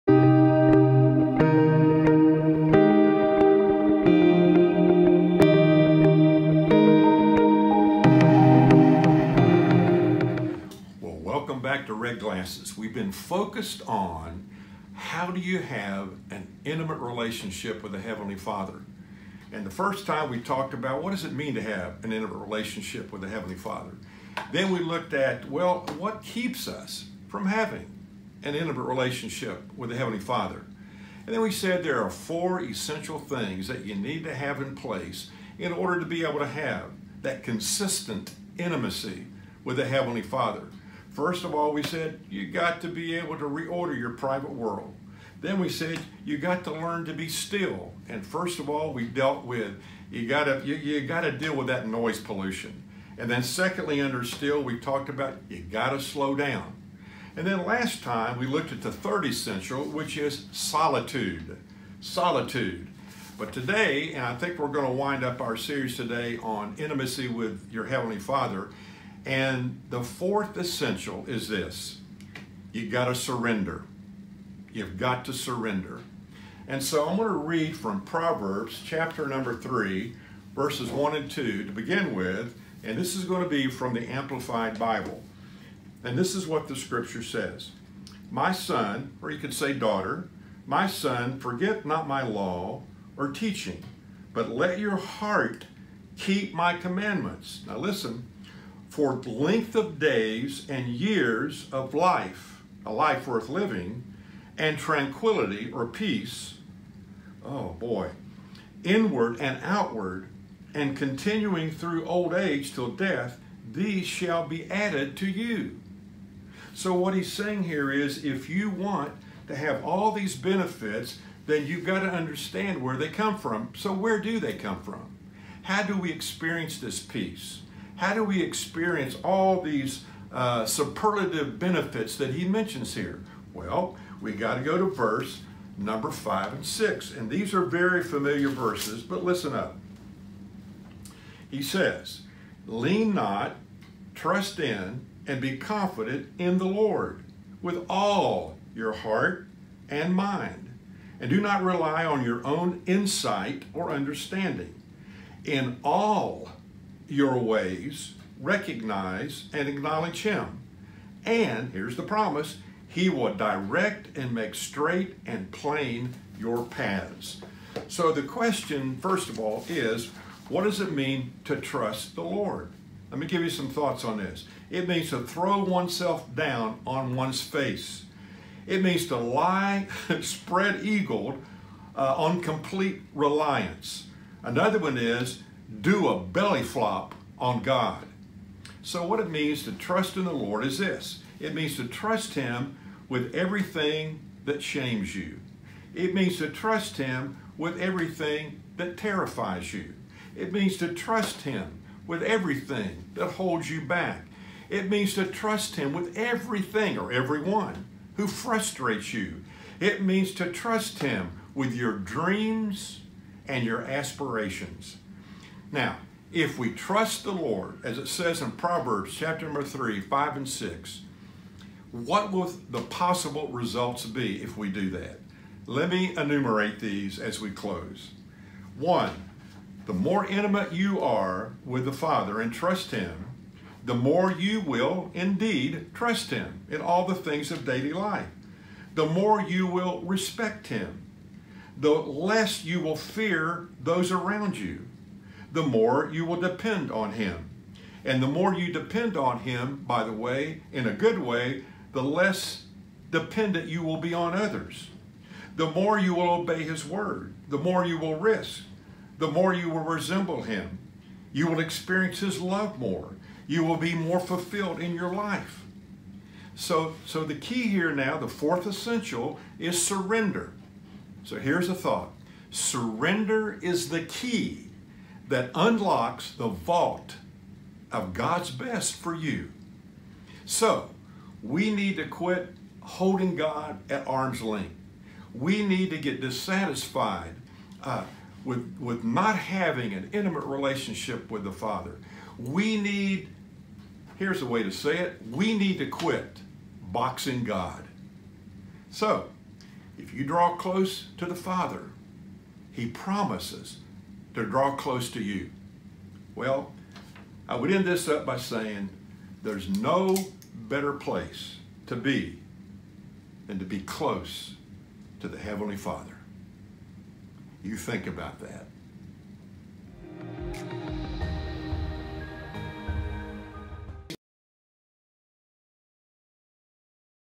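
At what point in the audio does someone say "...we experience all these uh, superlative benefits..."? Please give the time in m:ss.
2:08.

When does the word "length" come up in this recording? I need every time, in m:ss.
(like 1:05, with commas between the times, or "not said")
1:39, 4:44.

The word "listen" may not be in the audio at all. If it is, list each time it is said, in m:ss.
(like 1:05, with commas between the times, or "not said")
1:37, 2:19.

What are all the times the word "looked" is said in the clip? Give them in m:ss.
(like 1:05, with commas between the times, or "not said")
0:24, 0:58.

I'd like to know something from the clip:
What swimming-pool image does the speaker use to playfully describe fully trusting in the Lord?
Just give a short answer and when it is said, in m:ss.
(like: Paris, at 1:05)
Belly flop, at 3:06.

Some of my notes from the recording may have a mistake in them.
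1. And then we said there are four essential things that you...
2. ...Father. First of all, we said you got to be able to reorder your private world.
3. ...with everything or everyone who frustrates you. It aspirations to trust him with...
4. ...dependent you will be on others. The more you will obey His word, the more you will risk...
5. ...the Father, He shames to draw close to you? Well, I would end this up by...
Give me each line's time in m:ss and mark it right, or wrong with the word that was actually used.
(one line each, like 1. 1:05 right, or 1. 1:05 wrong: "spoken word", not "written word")
1. 0:31 right
2. 0:40 right
3. 3:25 wrong: "means", not "aspirations"
4. 4:13 right
5. 5:01 wrong: "promises", not "shames".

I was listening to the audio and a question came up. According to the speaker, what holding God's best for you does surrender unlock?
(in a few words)
The vault.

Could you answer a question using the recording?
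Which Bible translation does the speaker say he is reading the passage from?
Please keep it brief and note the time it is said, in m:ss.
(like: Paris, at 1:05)
Amplified Bible, at 1:24.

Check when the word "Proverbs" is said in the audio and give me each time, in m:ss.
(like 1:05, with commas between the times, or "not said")
1:18, 3:38.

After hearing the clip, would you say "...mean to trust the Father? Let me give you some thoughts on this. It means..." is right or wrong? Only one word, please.
wrong.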